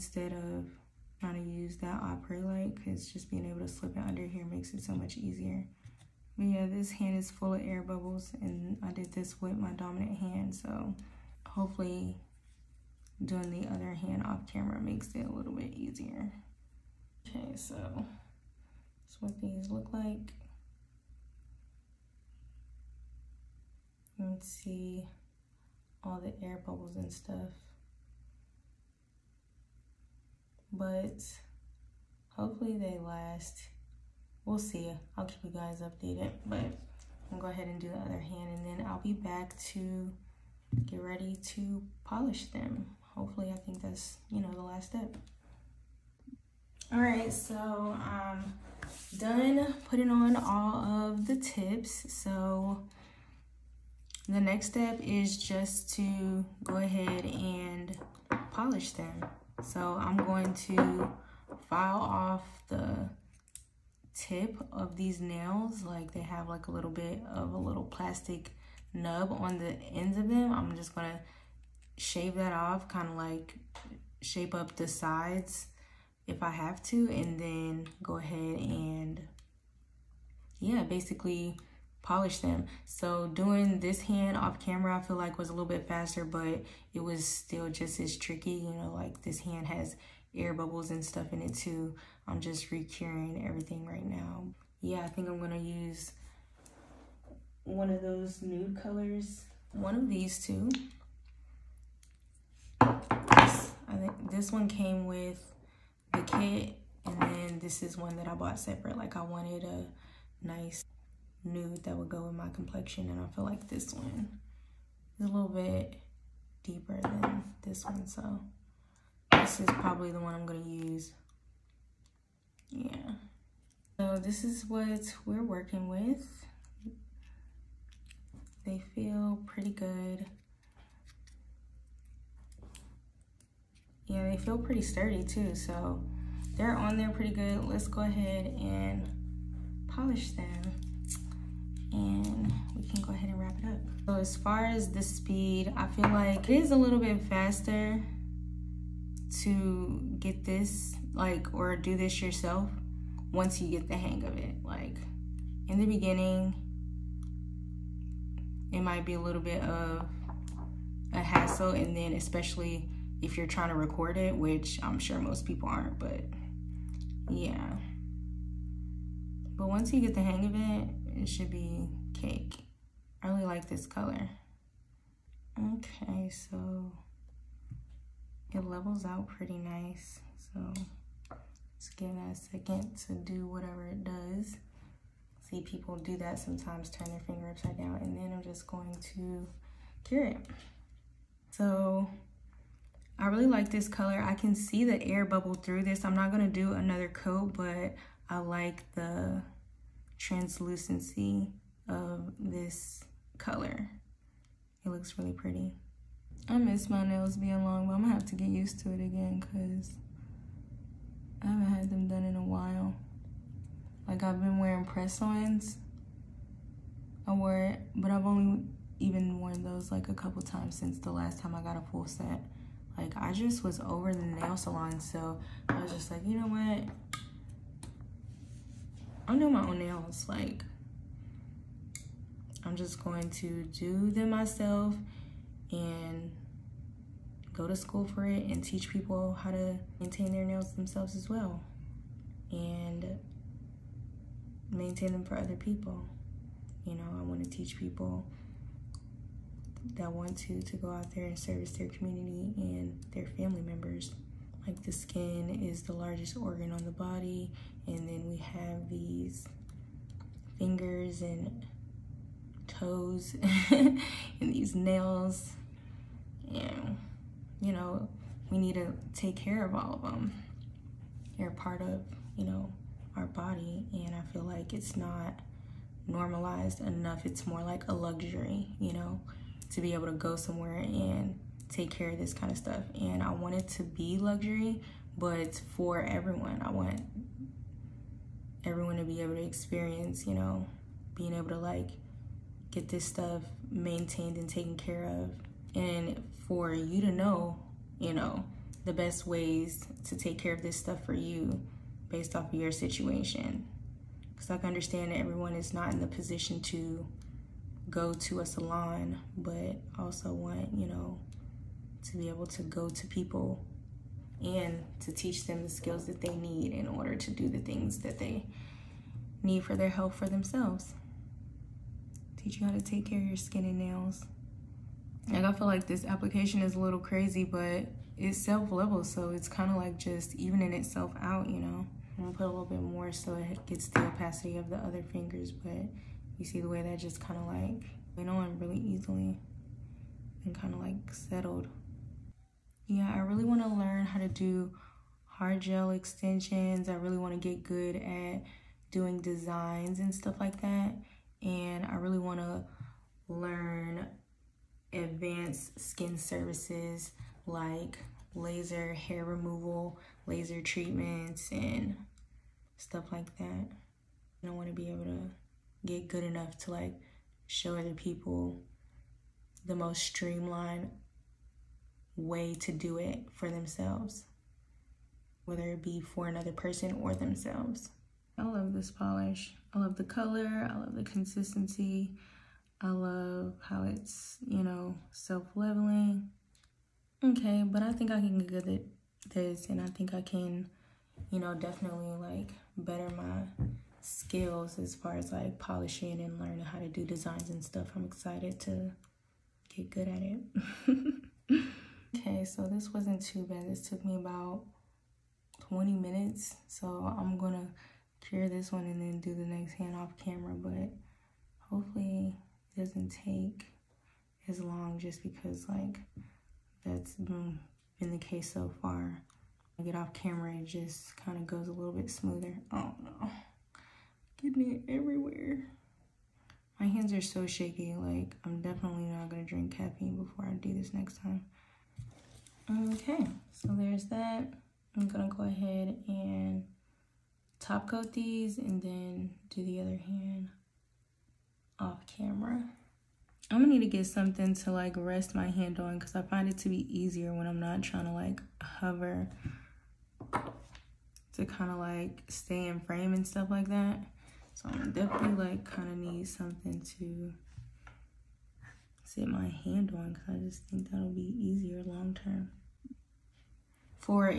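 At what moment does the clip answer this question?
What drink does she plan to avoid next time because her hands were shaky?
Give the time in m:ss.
7:09.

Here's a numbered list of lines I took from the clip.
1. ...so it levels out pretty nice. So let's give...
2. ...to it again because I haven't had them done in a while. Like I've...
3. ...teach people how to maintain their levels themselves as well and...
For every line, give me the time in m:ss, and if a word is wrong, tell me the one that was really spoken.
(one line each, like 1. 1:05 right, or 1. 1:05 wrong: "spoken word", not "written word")
1. 2:56 right
2. 3:28 right
3. 3:58 wrong: "nails", not "levels".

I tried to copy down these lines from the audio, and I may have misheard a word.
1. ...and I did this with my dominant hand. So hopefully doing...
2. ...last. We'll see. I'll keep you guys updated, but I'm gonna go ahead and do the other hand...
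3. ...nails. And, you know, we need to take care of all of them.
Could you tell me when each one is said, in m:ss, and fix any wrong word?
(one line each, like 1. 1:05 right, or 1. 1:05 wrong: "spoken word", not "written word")
1. 0:08 right
2. 0:32 right
3. 4:24 right.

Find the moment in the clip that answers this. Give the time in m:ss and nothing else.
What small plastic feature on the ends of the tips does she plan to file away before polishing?
1:07.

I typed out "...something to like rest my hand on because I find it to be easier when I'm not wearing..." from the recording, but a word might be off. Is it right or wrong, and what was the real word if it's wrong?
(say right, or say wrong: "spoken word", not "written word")
wrong: "trying", not "wearing".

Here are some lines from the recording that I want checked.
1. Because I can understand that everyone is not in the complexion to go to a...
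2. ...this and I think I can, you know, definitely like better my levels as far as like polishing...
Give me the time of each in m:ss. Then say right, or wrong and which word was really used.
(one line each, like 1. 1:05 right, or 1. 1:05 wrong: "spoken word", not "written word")
1. 5:04 wrong: "position", not "complexion"
2. 6:29 wrong: "skills", not "levels".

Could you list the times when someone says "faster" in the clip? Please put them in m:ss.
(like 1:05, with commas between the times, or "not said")
1:25, 2:27.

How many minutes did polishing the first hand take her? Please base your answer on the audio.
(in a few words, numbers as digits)
20 minutes.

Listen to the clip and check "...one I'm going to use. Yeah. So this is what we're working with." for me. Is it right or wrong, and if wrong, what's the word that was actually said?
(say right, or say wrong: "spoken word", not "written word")
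right.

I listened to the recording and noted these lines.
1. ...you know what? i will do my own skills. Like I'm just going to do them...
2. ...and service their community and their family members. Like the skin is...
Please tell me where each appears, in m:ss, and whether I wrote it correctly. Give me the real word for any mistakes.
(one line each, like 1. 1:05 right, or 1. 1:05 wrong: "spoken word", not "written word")
1. 3:46 wrong: "nails", not "skills"
2. 4:11 right.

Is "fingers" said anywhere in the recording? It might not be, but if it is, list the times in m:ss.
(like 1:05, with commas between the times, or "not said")
3:07, 4:20, 5:35.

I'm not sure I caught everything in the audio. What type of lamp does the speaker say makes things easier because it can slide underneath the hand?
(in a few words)
opera light.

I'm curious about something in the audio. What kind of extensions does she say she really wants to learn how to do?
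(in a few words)
hard gel extensions.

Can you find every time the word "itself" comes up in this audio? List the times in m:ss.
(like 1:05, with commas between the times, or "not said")
5:30.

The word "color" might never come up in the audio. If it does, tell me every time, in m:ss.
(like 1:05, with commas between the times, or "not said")
1:38, 2:53, 3:13, 3:23, 6:20.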